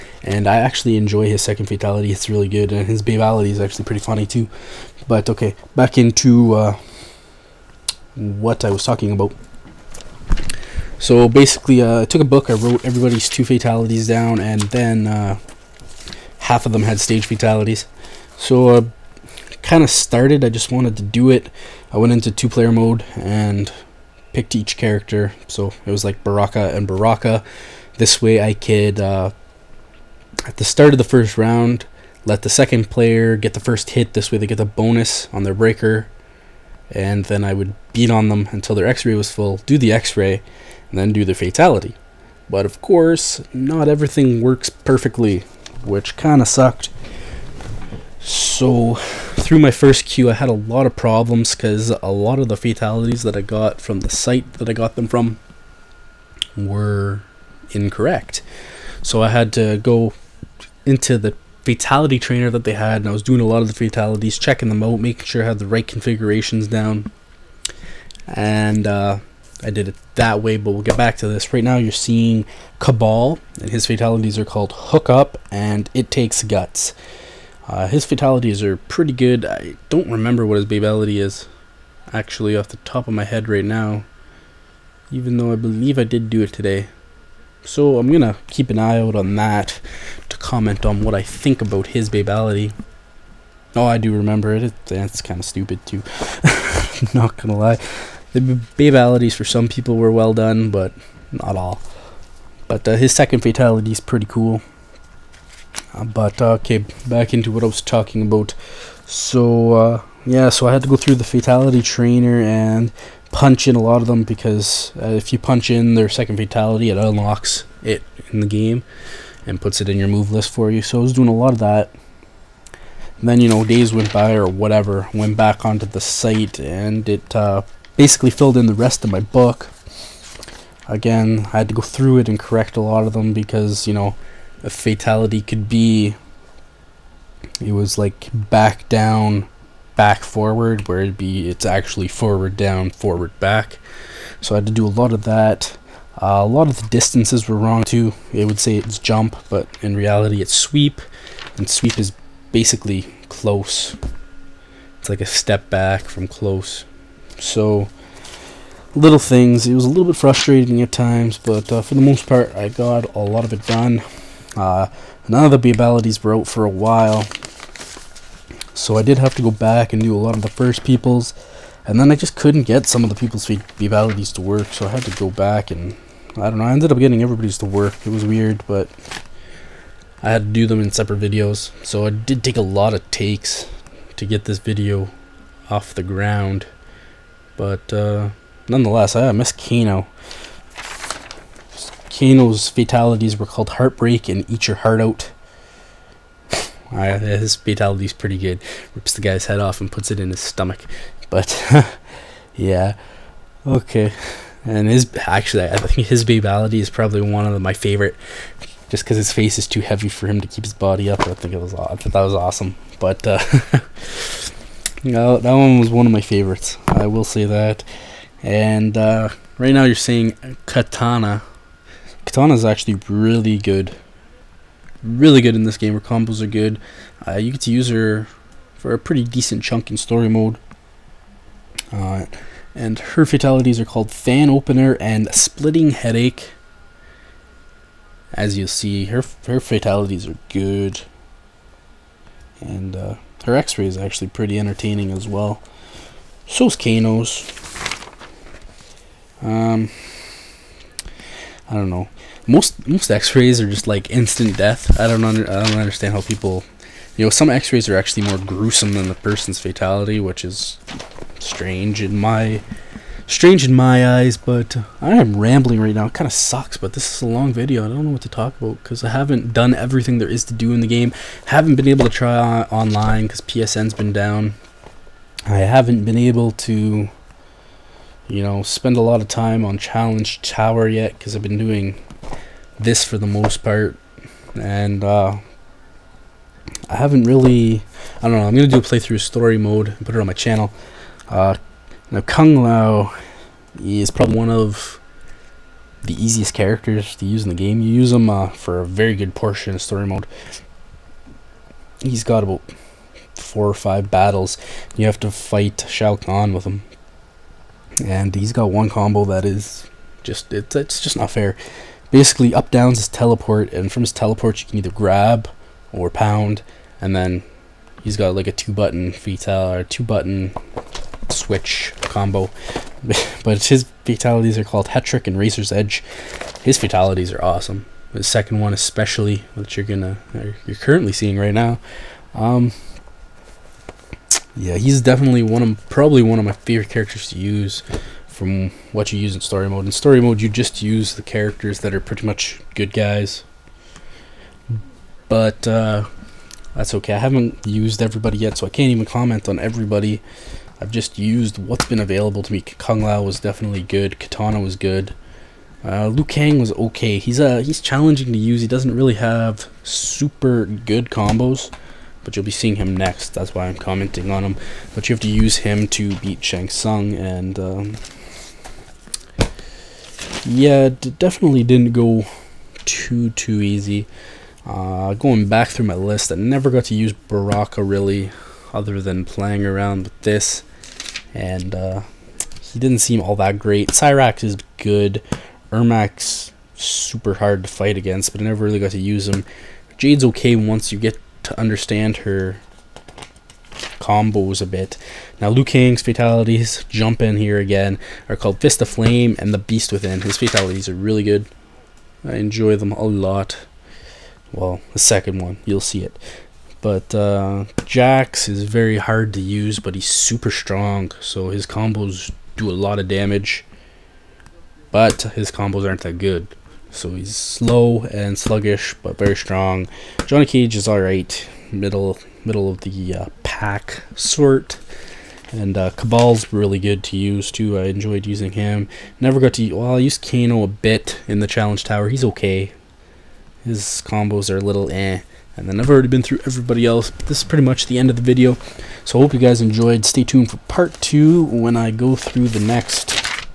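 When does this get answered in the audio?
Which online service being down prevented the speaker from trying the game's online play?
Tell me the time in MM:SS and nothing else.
04:33.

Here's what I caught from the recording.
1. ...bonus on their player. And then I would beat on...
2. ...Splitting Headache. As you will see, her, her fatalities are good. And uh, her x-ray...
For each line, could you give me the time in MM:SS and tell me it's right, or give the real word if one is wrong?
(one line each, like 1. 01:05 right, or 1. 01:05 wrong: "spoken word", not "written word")
1. 00:34 wrong: "breaker", not "player"
2. 03:55 right.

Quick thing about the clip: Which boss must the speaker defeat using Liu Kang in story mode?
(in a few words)
Shang Tsung.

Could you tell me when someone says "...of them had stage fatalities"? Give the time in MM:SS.
00:16.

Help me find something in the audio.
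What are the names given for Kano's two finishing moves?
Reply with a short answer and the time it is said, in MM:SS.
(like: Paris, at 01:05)
Heartbreak and Eat Your Heart Out, at 03:13.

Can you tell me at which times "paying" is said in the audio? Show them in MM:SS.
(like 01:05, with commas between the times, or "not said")
not said.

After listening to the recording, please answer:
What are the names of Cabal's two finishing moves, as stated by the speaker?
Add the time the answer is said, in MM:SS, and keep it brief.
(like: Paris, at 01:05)
Hook Up and It Takes Guts, at 01:14.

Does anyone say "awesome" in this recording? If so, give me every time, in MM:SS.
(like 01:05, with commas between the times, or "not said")
03:32, 05:27.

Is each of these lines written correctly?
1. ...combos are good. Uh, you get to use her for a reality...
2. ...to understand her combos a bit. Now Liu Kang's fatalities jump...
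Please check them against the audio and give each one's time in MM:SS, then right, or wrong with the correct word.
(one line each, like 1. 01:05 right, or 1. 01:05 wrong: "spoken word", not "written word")
1. 03:46 wrong: "pretty", not "reality"
2. 06:31 right.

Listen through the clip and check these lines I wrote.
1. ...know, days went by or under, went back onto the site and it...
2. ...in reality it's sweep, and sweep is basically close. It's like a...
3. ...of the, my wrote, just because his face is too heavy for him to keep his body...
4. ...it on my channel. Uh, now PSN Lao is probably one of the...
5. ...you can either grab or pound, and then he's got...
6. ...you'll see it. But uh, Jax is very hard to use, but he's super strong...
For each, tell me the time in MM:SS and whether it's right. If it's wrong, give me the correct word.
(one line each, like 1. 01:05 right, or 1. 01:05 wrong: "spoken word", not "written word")
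1. 02:03 wrong: "whatever", not "under"
2. 02:29 right
3. 03:27 wrong: "favorite", not "wrote"
4. 04:50 wrong: "Kung", not "PSN"
5. 05:14 right
6. 06:45 right.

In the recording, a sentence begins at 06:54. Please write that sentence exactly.
But his combos aren't that good.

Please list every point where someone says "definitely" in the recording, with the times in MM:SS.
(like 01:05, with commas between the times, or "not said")
05:35, 05:53, 06:10.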